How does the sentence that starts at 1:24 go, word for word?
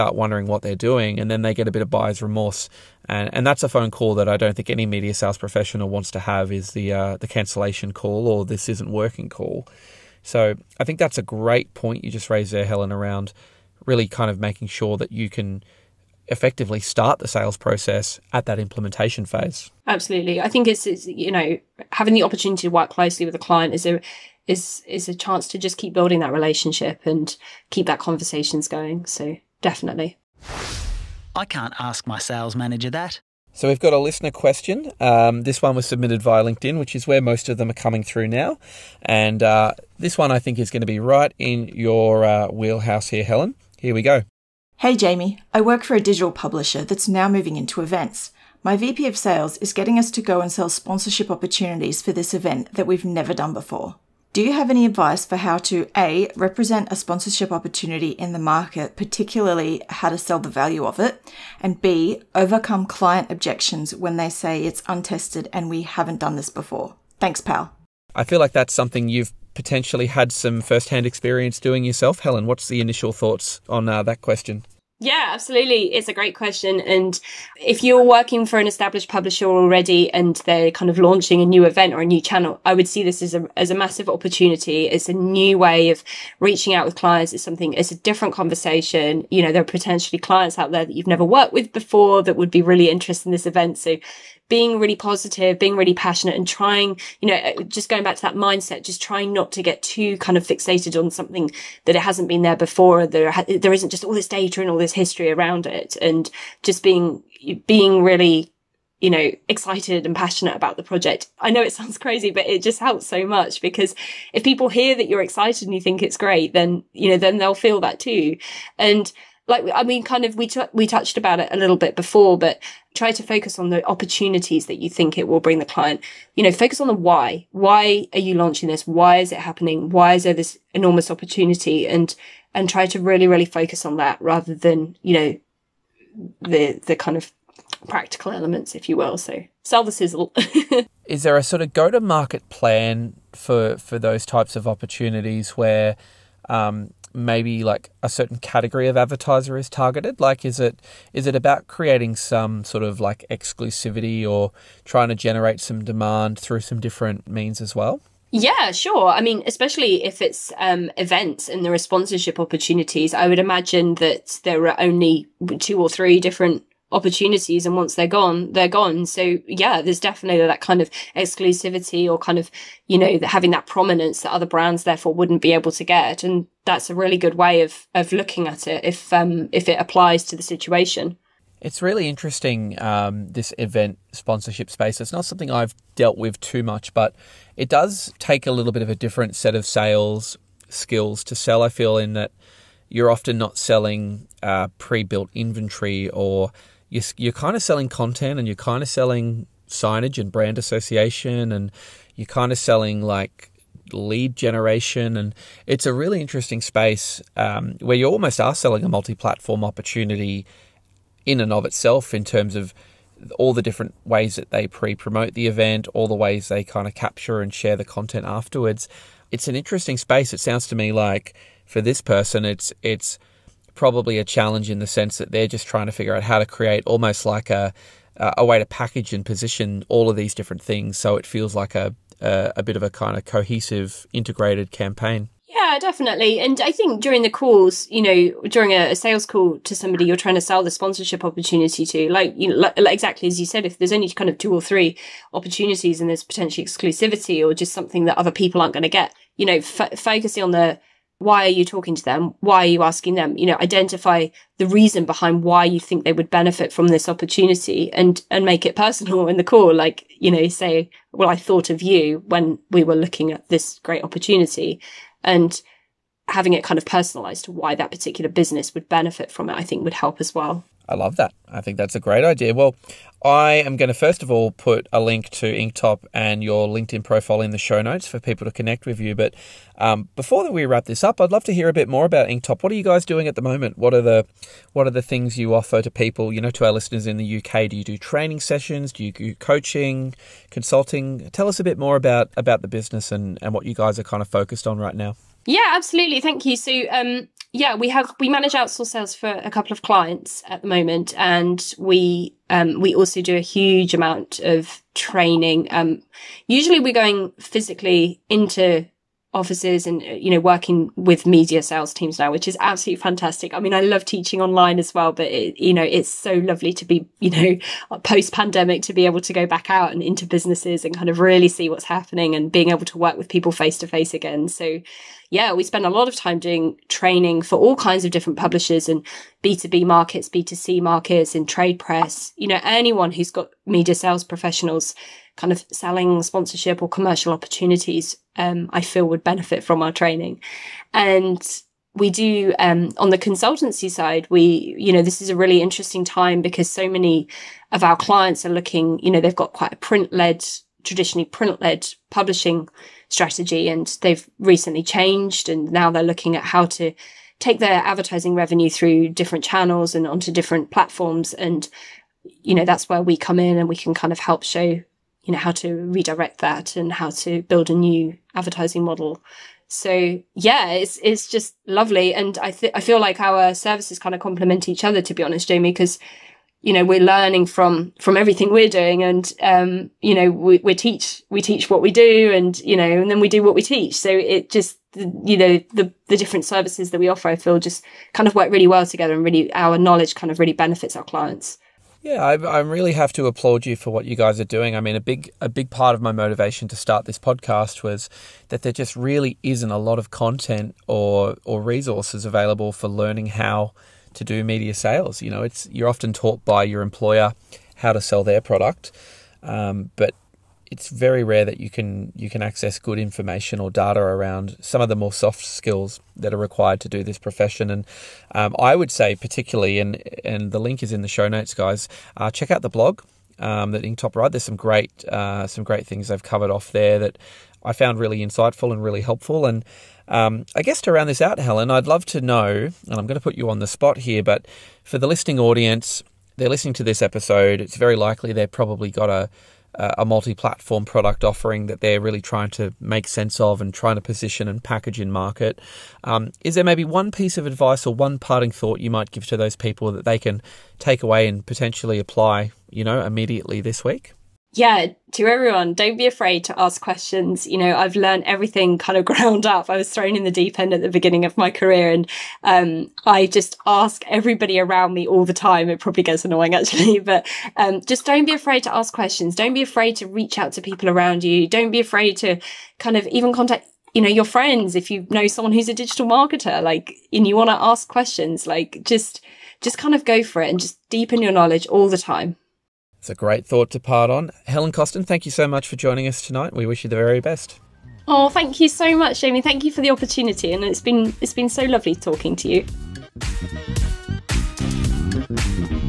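It's a new way of reaching out with clients.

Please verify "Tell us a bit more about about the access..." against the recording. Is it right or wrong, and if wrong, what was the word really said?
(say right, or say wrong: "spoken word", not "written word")
wrong: "business", not "access".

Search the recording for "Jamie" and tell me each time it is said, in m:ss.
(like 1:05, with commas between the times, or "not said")
0:44, 6:15, 8:09.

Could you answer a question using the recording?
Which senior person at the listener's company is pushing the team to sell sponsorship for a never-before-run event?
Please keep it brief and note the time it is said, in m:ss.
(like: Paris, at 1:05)
VP of Sales, at 0:48.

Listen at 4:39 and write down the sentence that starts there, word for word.
But um, before we wrap this up, I'd love to hear a bit more about Inktop.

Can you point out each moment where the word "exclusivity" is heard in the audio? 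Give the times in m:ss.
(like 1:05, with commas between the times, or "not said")
2:33, 2:51, 4:06.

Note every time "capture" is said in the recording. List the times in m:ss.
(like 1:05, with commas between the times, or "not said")
3:36.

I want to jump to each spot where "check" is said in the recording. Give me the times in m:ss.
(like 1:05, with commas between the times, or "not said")
7:02.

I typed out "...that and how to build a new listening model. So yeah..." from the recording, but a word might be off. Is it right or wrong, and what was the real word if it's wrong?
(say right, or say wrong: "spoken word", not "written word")
wrong: "advertising", not "listening".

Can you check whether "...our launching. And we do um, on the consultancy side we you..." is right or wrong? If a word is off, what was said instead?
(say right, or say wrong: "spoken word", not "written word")
wrong: "training", not "launching".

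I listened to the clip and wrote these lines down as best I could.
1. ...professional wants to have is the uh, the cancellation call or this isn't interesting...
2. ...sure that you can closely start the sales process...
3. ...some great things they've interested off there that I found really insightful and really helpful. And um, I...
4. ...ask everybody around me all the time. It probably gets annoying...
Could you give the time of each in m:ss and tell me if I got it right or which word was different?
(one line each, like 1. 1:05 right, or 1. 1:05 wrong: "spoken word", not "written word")
1. 0:05 wrong: "working", not "interesting"
2. 0:14 wrong: "effectively", not "closely"
3. 7:05 wrong: "covered", not "interested"
4. 7:43 right.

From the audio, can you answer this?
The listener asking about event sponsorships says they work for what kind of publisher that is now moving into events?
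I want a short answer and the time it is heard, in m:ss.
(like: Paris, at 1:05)
Digital publisher, at 0:46.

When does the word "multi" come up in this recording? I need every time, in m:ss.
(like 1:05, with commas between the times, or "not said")
3:28, 7:20.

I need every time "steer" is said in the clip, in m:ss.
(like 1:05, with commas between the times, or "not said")
not said.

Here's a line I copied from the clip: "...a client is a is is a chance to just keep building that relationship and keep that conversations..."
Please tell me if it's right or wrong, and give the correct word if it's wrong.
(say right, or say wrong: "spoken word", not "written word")
right.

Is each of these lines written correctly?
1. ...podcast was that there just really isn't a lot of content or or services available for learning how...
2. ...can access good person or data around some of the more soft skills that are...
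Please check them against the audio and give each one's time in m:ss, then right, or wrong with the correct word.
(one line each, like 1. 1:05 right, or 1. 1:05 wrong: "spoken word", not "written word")
1. 6:37 wrong: "resources", not "services"
2. 6:52 wrong: "information", not "person".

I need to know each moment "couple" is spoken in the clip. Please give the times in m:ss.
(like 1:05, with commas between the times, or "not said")
4:59.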